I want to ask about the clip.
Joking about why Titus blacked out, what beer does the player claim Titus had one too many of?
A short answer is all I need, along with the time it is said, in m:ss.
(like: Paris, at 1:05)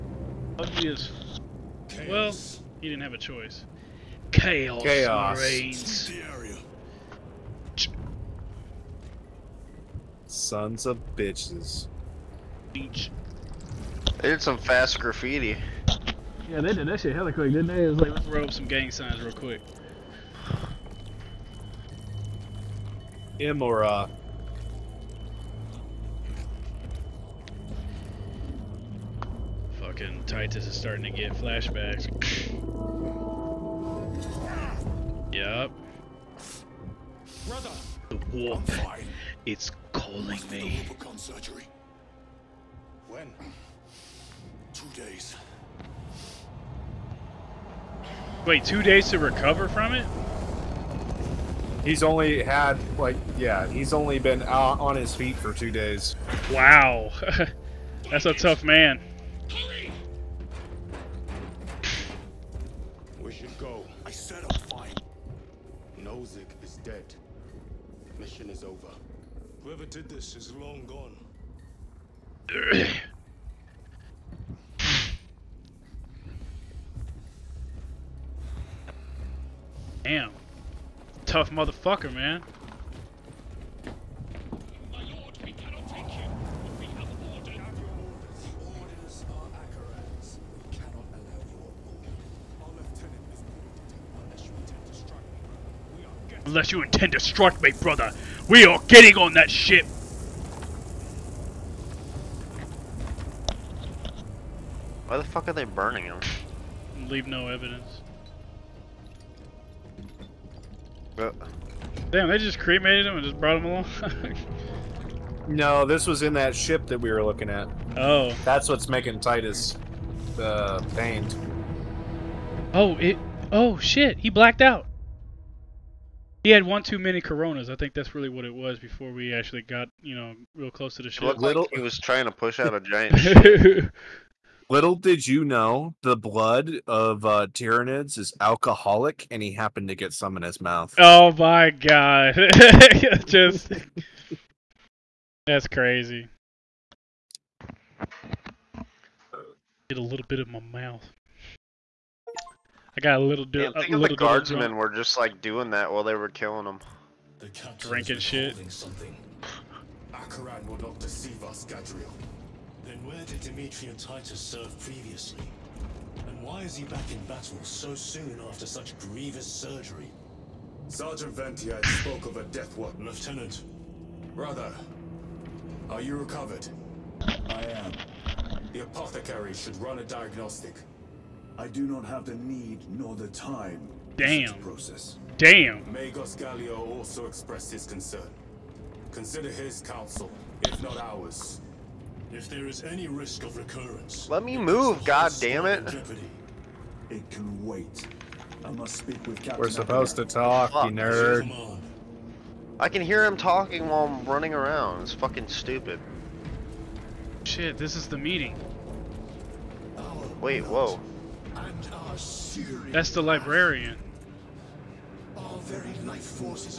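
Coronas, at 2:07.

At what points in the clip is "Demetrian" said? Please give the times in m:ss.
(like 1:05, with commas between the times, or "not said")
2:43.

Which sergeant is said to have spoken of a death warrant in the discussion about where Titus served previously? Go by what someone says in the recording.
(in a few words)
Sergeant Ventiad.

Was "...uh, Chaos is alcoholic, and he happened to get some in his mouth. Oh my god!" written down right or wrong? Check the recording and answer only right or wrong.
wrong.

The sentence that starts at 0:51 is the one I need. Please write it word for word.
He's only had, like, yeah, he's only been out on his feet for two days.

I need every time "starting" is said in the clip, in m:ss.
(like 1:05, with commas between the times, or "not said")
0:30.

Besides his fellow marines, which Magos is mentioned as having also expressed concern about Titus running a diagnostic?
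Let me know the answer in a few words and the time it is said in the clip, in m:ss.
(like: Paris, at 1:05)
Magos Gallio, at 3:05.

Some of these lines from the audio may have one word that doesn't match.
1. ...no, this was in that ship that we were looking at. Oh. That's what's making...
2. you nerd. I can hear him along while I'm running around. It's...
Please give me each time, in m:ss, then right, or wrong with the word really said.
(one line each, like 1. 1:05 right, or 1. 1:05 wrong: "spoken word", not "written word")
1. 1:55 right
2. 3:20 wrong: "talking", not "along".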